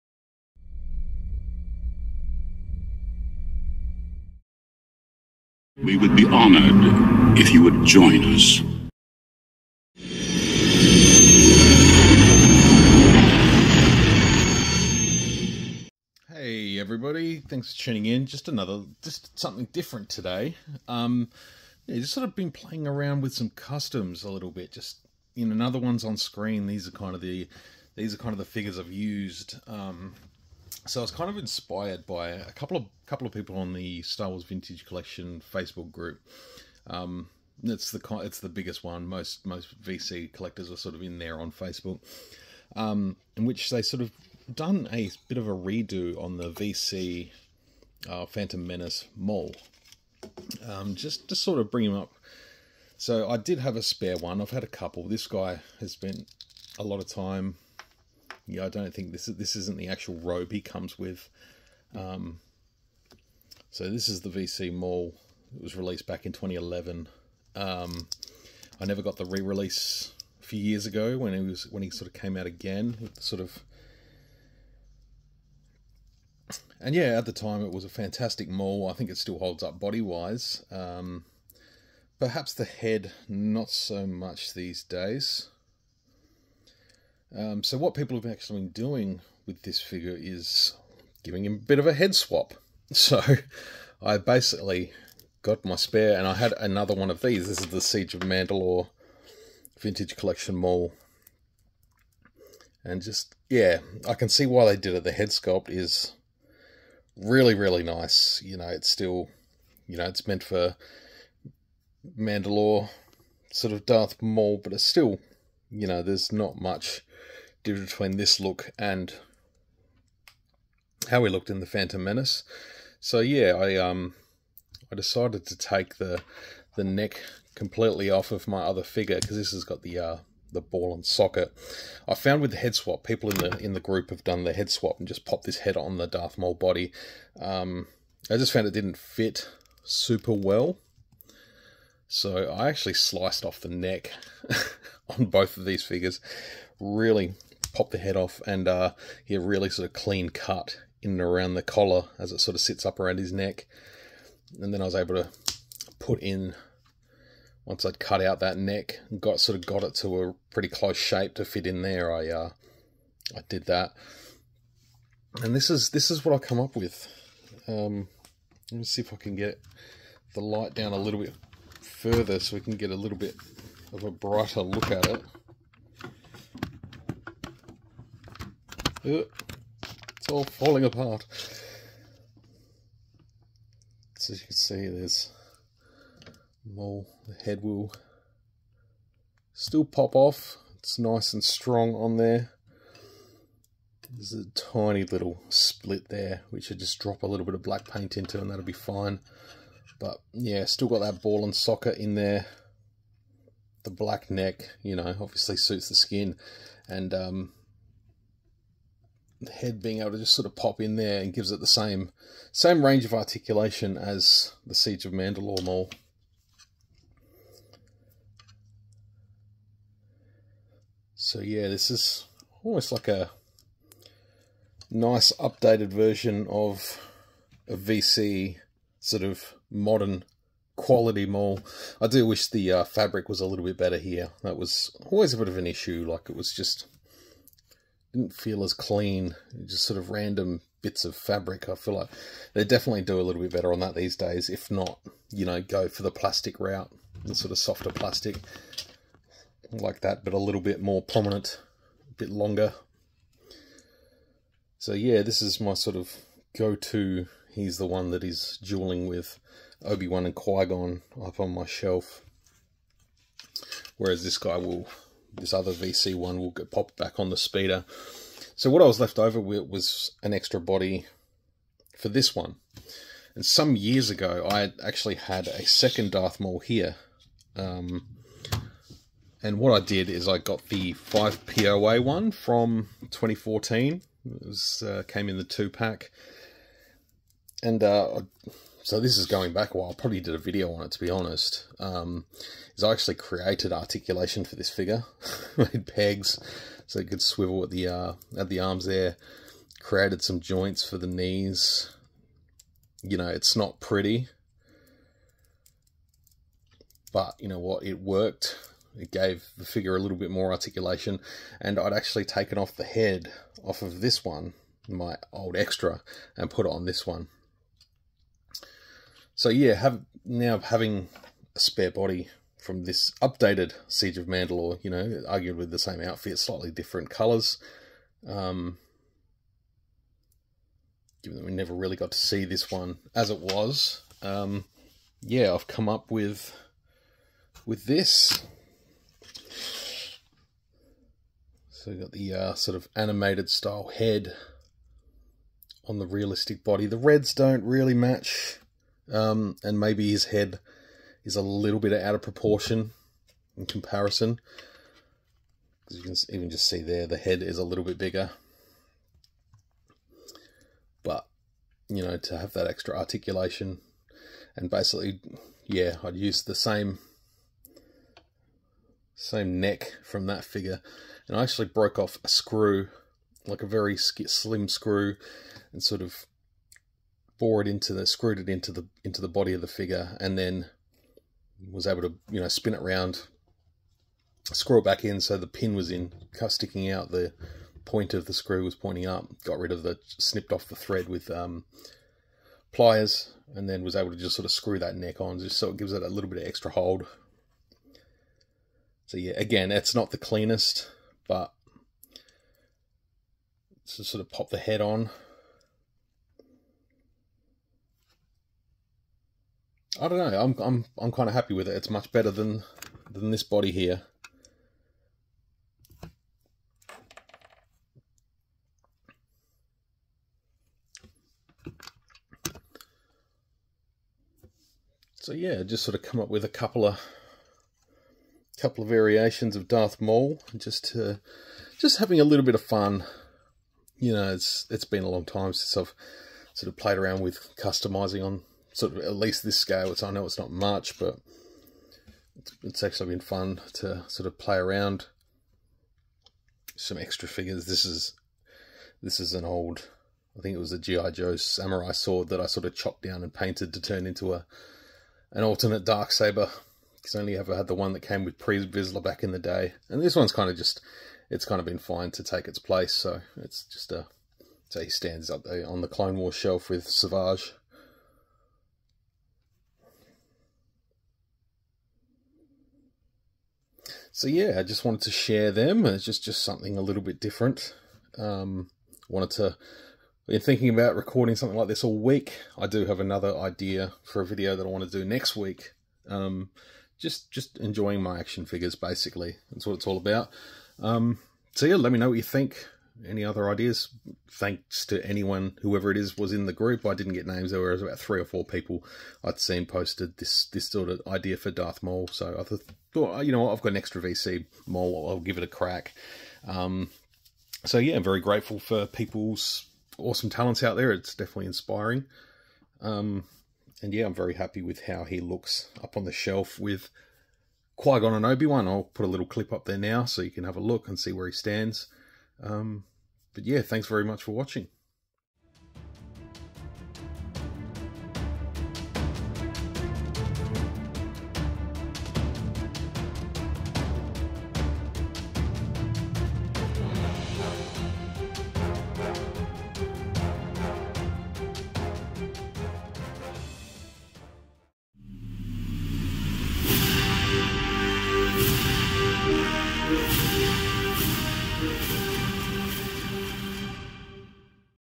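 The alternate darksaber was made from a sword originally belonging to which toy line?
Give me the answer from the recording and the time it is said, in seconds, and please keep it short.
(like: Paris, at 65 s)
GI Joe, at 450 s.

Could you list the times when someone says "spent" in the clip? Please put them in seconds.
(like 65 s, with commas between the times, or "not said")
55 s.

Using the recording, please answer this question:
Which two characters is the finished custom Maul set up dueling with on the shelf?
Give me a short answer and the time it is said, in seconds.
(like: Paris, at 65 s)
Obi-Wan and Qui-Gon, at 259 s.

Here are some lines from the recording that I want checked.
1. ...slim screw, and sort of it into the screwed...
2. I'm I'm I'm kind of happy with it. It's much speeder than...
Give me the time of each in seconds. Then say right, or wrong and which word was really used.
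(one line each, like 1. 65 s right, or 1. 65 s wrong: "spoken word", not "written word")
1. 373 s right
2. 410 s wrong: "better", not "speeder".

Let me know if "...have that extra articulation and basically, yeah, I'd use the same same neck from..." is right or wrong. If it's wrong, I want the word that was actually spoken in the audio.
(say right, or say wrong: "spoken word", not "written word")
right.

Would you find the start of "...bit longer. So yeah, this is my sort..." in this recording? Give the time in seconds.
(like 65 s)
252 s.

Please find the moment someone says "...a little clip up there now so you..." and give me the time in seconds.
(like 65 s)
519 s.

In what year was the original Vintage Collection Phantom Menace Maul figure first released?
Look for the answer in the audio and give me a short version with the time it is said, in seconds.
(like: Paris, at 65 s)
2011, at 66 s.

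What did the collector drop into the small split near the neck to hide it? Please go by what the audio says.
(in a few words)
black paint.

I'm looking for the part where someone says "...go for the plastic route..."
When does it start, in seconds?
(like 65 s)
245 s.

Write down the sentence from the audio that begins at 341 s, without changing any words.
So we've got the uh, sort of animated style head on the realistic body.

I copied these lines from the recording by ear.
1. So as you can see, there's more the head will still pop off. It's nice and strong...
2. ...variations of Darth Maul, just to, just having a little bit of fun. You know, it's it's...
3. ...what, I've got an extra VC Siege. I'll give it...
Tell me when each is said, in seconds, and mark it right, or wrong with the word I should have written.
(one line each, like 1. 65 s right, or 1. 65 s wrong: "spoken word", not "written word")
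1. 184 s right
2. 428 s right
3. 503 s wrong: "Maul", not "Siege".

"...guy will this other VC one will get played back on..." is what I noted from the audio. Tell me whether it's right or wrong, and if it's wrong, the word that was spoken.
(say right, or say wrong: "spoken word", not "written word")
wrong: "popped", not "played".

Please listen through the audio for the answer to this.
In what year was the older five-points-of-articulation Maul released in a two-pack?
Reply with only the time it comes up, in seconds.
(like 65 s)
283 s.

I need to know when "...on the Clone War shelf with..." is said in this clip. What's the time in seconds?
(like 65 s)
465 s.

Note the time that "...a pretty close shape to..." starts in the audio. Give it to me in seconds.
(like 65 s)
160 s.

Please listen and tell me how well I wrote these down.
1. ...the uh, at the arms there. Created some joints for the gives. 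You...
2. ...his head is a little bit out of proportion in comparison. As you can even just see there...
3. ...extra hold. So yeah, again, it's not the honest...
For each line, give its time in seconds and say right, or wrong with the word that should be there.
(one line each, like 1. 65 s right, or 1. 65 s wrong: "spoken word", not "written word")
1. 297 s wrong: "knees", not "gives"
2. 350 s right
3. 396 s wrong: "cleanest", not "honest".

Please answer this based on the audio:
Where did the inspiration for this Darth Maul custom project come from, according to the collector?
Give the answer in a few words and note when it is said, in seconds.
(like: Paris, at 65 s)
Star Wars Vintage Collection Facebook group, at 34 s.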